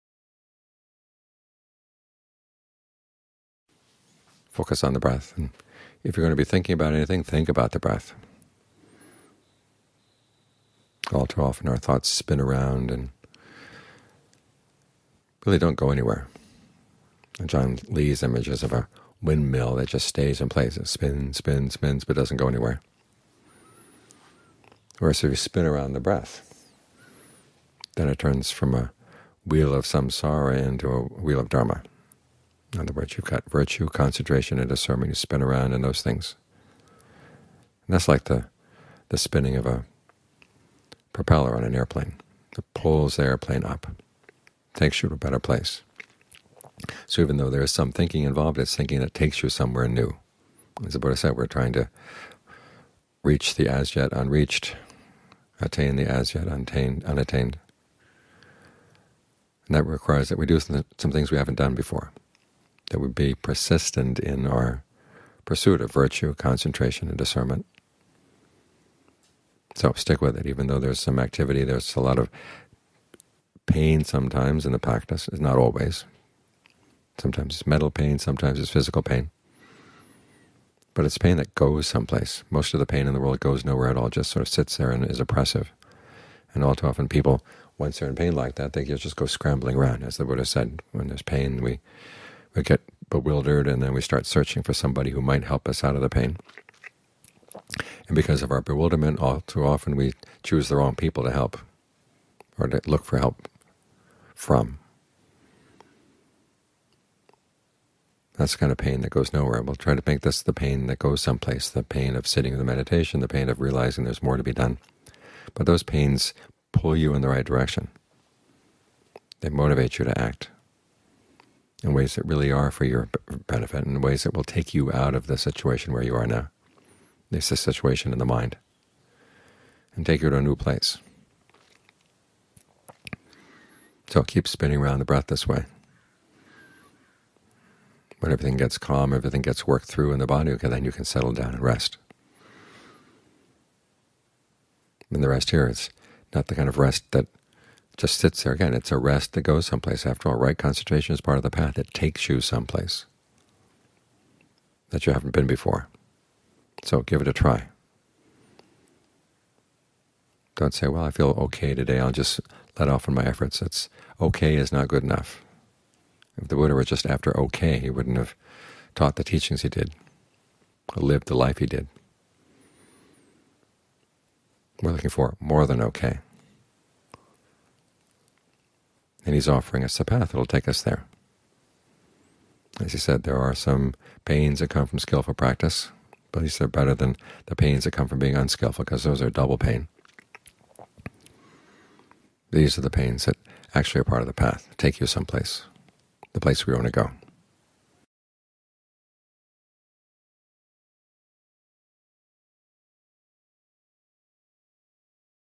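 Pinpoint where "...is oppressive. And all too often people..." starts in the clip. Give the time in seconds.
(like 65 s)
85 s.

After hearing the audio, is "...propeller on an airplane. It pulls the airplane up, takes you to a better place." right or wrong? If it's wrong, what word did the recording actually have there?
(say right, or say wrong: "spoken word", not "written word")
right.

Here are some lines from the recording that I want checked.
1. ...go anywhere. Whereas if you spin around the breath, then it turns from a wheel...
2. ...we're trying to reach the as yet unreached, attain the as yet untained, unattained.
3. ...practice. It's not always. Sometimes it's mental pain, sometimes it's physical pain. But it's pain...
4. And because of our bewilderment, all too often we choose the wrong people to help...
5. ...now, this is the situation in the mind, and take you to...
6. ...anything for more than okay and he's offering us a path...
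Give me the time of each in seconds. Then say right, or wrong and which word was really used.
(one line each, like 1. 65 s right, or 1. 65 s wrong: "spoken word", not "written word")
1. 22 s right
2. 51 s right
3. 74 s right
4. 98 s right
5. 126 s right
6. 174 s wrong: "looking", not "anything".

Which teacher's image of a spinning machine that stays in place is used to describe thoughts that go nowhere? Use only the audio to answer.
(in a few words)
Ajaan Lee.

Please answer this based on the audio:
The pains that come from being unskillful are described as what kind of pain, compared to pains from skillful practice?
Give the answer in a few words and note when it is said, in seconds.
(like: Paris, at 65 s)
double pain, at 189 s.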